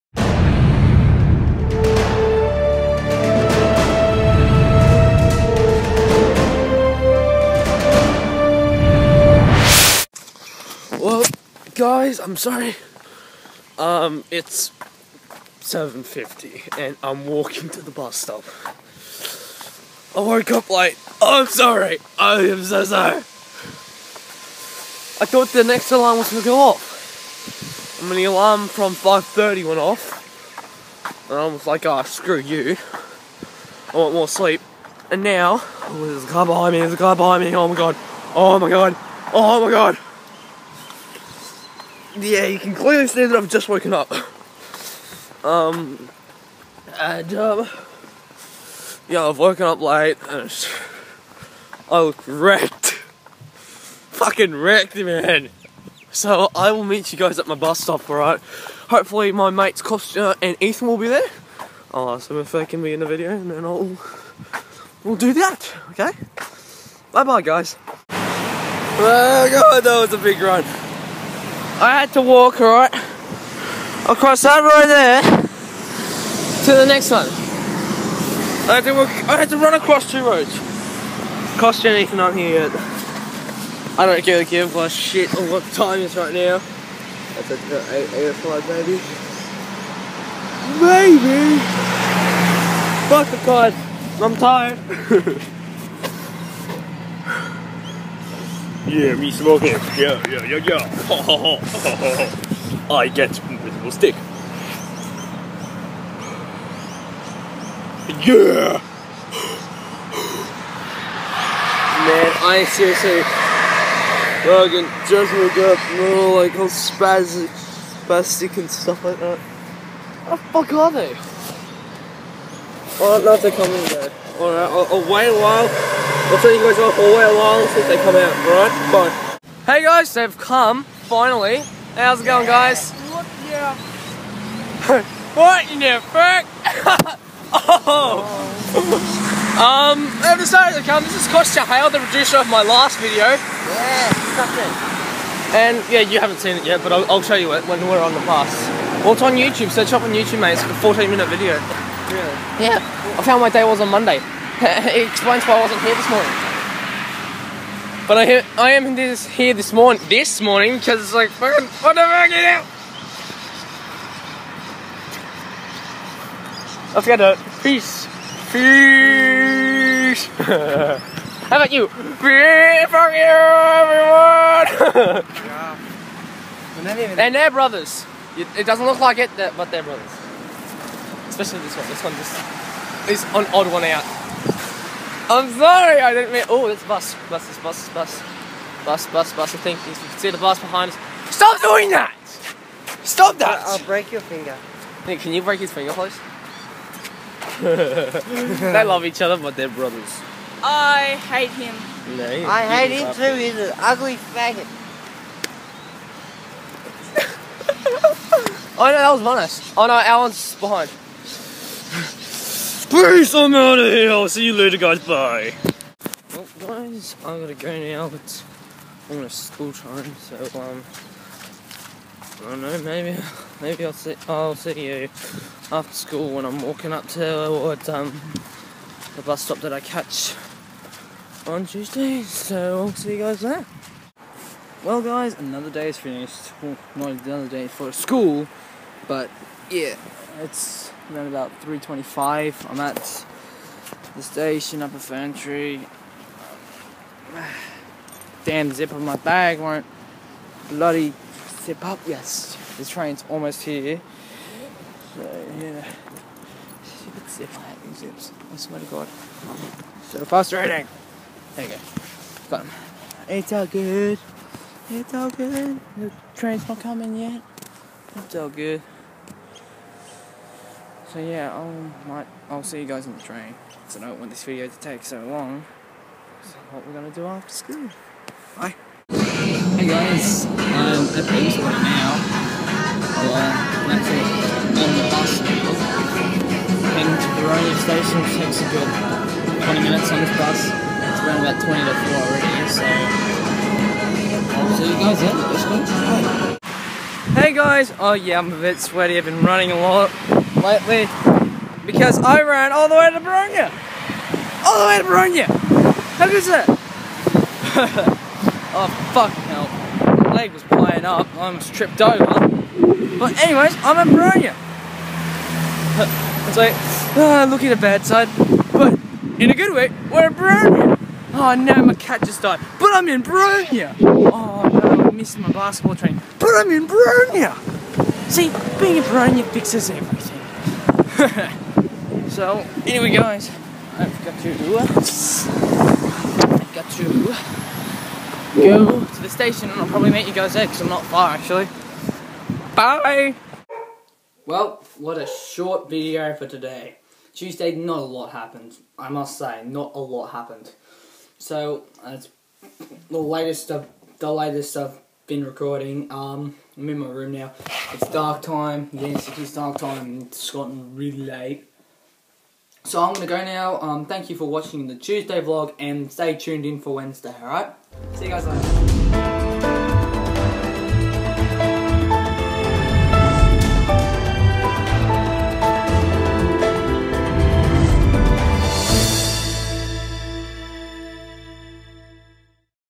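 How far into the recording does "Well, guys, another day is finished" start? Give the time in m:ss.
3:54.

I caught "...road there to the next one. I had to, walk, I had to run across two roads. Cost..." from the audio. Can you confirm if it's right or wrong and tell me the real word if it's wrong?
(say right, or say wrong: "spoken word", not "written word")
right.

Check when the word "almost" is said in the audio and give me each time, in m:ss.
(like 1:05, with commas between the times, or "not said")
3:39, 4:13, 5:11.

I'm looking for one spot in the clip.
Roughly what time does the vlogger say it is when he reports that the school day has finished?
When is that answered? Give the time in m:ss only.
4:01.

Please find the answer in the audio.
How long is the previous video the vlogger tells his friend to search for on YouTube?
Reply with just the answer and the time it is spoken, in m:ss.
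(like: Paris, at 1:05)
14 minutes, at 2:30.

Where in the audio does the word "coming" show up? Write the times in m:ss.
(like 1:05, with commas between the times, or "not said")
2:03, 4:26.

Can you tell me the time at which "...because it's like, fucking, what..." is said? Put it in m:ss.
2:40.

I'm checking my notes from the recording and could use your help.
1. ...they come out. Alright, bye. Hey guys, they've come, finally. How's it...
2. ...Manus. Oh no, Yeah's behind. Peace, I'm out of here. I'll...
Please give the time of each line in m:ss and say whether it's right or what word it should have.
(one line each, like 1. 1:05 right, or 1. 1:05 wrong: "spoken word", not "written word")
1. 2:07 right
2. 3:29 wrong: "Alan", not "Yeah".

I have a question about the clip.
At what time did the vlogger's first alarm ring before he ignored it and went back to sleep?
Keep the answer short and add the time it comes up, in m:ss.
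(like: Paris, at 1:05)
5.30, at 0:28.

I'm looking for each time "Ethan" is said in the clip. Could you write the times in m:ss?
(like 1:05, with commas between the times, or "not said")
1:00.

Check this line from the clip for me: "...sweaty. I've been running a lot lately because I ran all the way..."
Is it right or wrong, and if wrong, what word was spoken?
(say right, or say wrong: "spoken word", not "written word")
right.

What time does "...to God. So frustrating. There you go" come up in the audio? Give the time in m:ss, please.
4:18.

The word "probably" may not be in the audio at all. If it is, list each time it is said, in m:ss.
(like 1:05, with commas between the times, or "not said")
5:39.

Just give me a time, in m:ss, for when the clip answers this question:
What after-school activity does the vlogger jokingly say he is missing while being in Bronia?
5:25.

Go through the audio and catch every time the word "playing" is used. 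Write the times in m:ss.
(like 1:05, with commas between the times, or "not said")
5:10.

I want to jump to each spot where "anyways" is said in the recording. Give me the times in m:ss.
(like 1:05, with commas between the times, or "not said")
5:13, 5:32.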